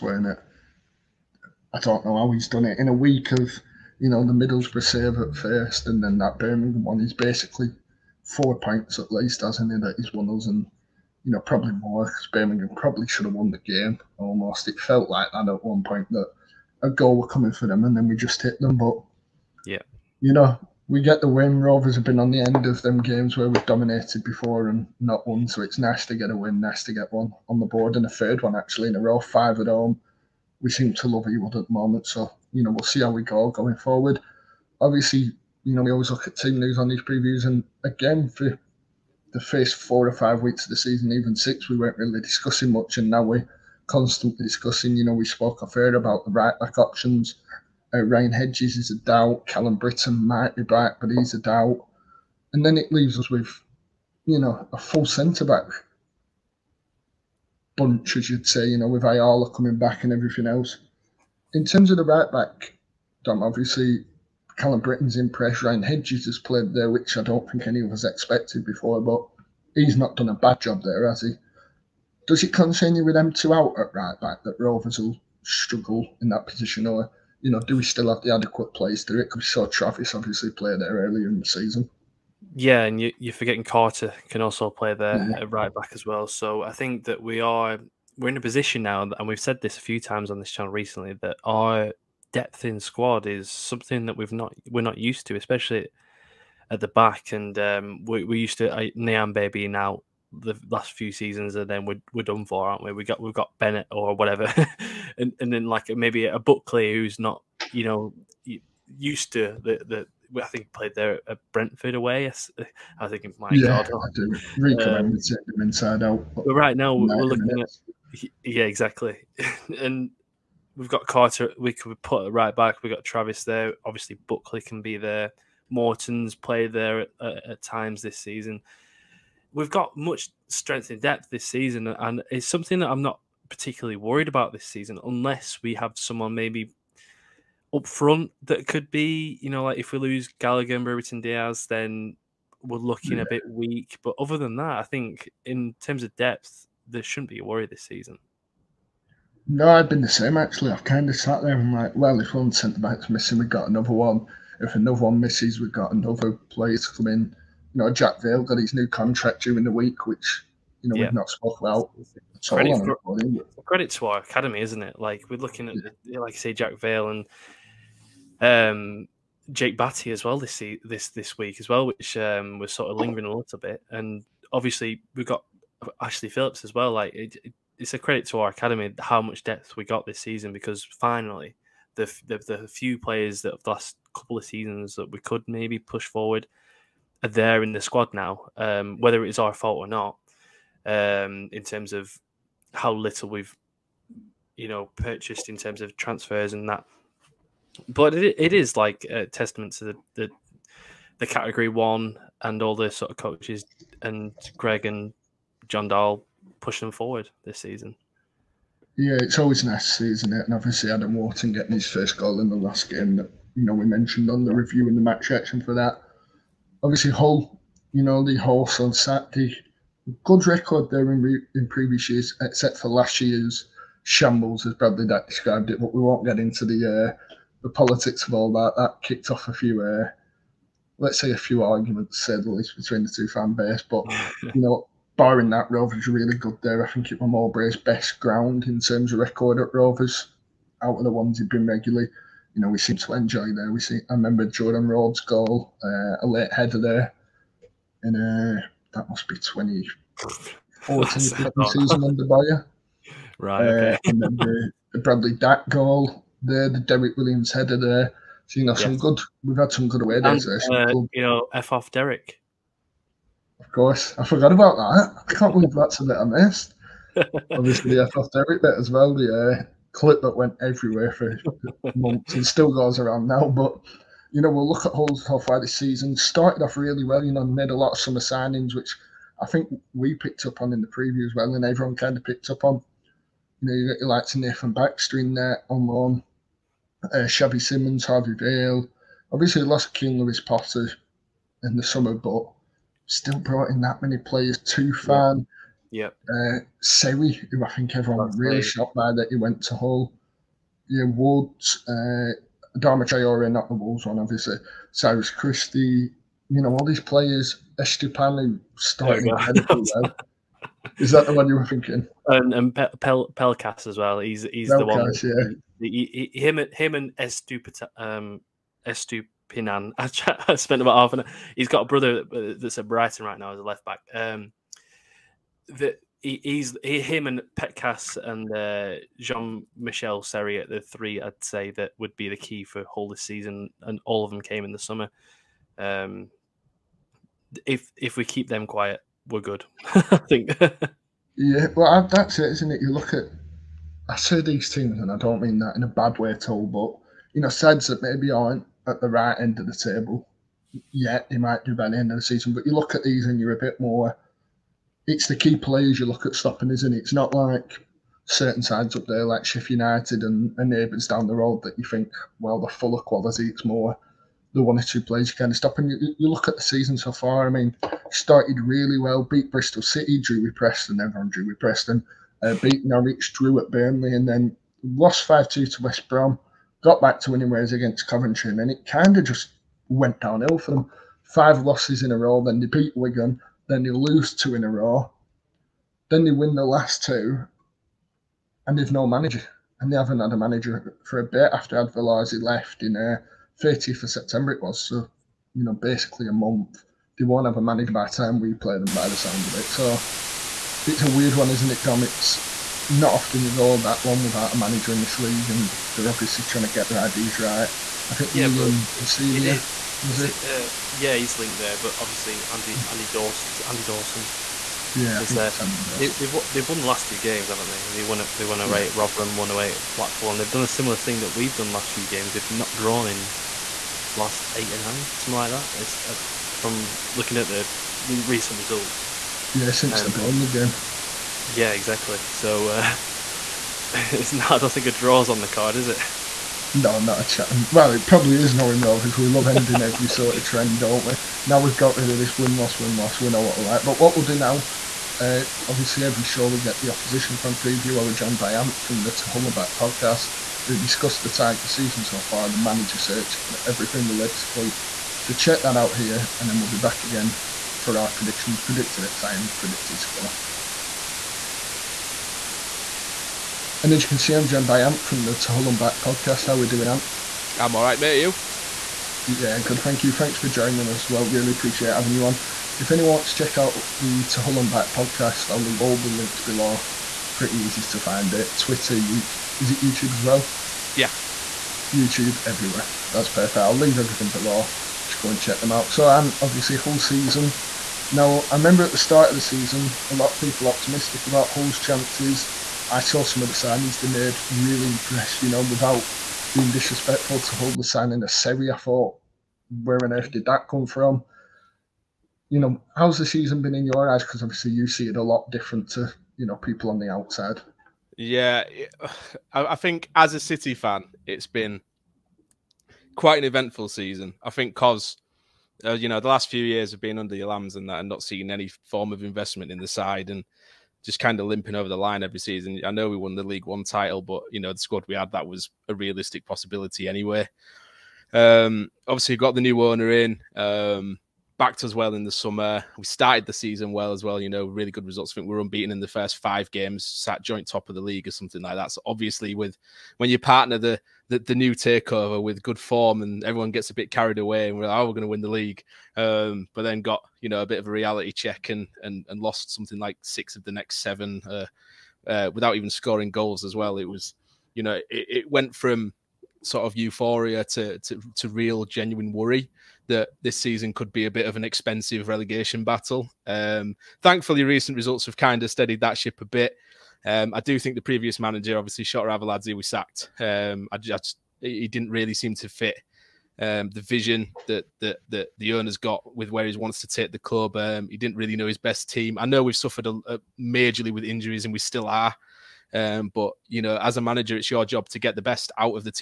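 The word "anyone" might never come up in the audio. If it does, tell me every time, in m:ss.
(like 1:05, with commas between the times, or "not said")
7:52.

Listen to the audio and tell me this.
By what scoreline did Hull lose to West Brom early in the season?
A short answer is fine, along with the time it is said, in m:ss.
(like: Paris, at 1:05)
5-2, at 6:15.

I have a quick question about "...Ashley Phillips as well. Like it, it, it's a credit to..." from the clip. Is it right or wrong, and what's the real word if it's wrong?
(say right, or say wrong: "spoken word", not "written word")
right.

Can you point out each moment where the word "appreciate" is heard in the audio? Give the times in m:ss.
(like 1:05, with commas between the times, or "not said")
7:51.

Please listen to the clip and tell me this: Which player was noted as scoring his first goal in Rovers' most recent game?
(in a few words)
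Adam Wharton.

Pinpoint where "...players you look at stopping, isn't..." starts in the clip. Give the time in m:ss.
5:55.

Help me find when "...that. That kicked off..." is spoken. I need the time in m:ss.
3:48.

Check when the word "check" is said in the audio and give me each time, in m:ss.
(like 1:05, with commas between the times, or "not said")
7:35, 7:53, 8:05, 9:08.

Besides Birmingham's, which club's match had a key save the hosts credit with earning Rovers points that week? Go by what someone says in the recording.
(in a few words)
Middlesbrough.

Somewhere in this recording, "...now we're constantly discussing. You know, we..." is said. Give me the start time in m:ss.
0:43.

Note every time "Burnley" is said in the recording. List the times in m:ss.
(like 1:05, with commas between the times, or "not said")
6:13, 7:10.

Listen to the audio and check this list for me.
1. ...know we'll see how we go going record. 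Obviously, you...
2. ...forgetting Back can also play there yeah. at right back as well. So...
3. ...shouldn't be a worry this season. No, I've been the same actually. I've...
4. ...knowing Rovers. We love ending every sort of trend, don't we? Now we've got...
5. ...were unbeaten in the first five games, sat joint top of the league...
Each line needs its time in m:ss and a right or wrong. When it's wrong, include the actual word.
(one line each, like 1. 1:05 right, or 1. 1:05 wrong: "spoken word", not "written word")
1. 0:32 wrong: "forward", not "record"
2. 1:23 wrong: "Carter", not "Back"
3. 2:27 right
4. 7:18 right
5. 8:55 right.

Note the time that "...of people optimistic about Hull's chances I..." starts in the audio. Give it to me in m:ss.
8:10.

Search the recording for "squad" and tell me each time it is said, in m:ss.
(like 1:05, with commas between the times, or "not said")
1:32, 3:07, 8:44.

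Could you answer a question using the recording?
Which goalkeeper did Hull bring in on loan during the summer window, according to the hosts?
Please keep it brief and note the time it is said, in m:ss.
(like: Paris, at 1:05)
Nathan Baxter, at 4:44.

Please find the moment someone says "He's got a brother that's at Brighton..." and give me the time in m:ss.
5:21.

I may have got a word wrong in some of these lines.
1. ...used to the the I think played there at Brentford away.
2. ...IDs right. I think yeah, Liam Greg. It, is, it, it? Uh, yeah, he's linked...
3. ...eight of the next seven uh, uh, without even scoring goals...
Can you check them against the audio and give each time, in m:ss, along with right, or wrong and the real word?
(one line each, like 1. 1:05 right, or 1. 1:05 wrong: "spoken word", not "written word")
1. 1:48 right
2. 6:47 wrong: "Rosenior", not "Greg"
3. 9:10 wrong: "six", not "eight".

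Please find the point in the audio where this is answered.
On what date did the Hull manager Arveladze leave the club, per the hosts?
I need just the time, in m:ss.
6:33.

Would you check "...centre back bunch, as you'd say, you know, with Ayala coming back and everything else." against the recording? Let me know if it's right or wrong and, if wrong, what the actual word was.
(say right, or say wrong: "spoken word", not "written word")
right.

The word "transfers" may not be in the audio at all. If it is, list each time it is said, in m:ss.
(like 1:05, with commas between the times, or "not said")
3:15.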